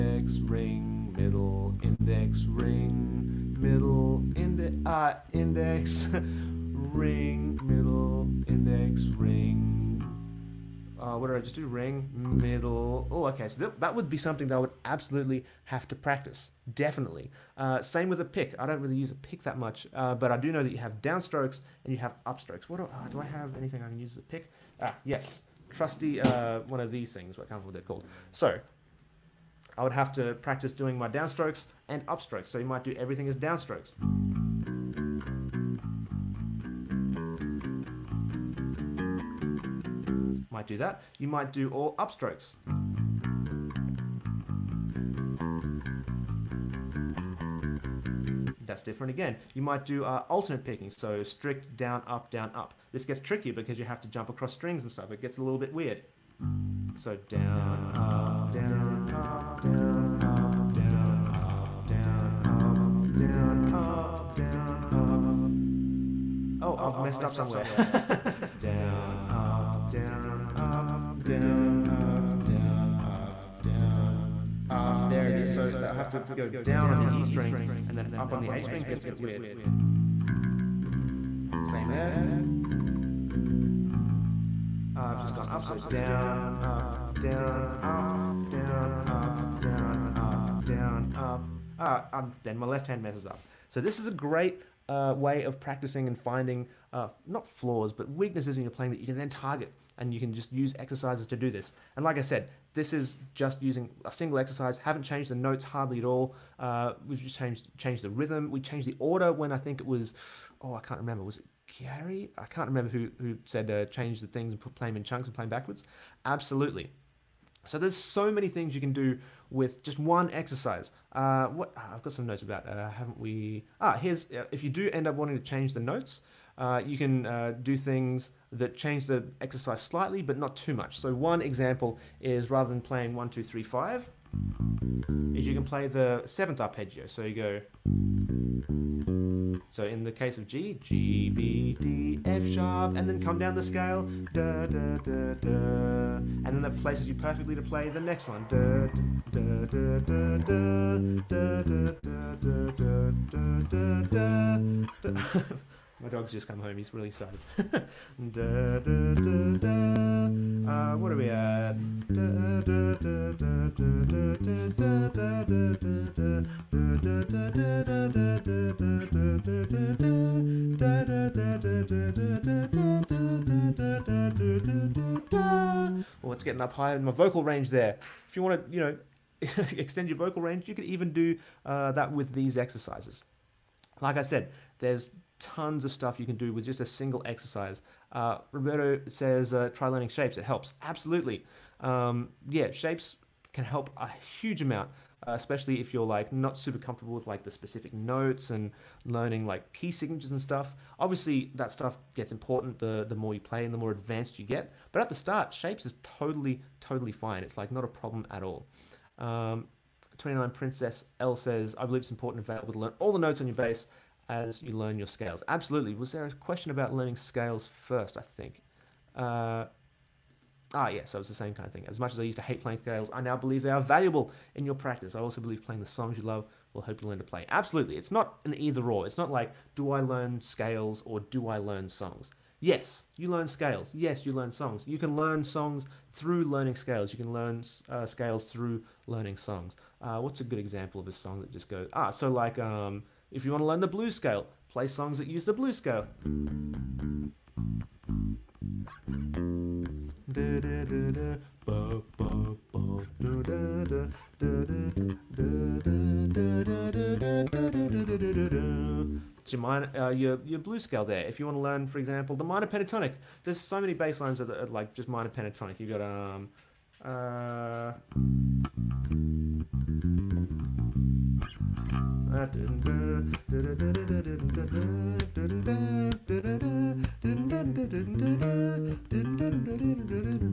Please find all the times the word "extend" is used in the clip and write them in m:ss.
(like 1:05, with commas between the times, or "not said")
2:59.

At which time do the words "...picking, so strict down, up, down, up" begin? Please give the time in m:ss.
0:50.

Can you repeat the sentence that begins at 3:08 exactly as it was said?
Uh, Roberto says, uh, try learning shapes.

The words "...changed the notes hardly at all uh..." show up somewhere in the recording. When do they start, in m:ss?
1:45.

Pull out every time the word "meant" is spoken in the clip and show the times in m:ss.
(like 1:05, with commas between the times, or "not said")
not said.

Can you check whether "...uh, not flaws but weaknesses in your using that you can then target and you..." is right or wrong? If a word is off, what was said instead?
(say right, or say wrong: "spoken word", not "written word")
wrong: "playing", not "using".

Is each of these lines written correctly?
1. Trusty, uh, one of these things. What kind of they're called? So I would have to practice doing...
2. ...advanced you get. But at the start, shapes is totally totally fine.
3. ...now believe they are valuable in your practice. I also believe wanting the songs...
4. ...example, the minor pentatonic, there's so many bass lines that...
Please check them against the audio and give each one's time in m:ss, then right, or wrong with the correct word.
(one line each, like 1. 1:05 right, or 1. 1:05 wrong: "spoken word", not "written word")
1. 0:25 right
2. 3:23 right
3. 3:43 wrong: "playing", not "wanting"
4. 4:21 right.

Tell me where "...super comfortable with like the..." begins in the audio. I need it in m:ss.
3:16.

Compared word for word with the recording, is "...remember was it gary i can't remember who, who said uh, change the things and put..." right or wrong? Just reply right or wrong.
right.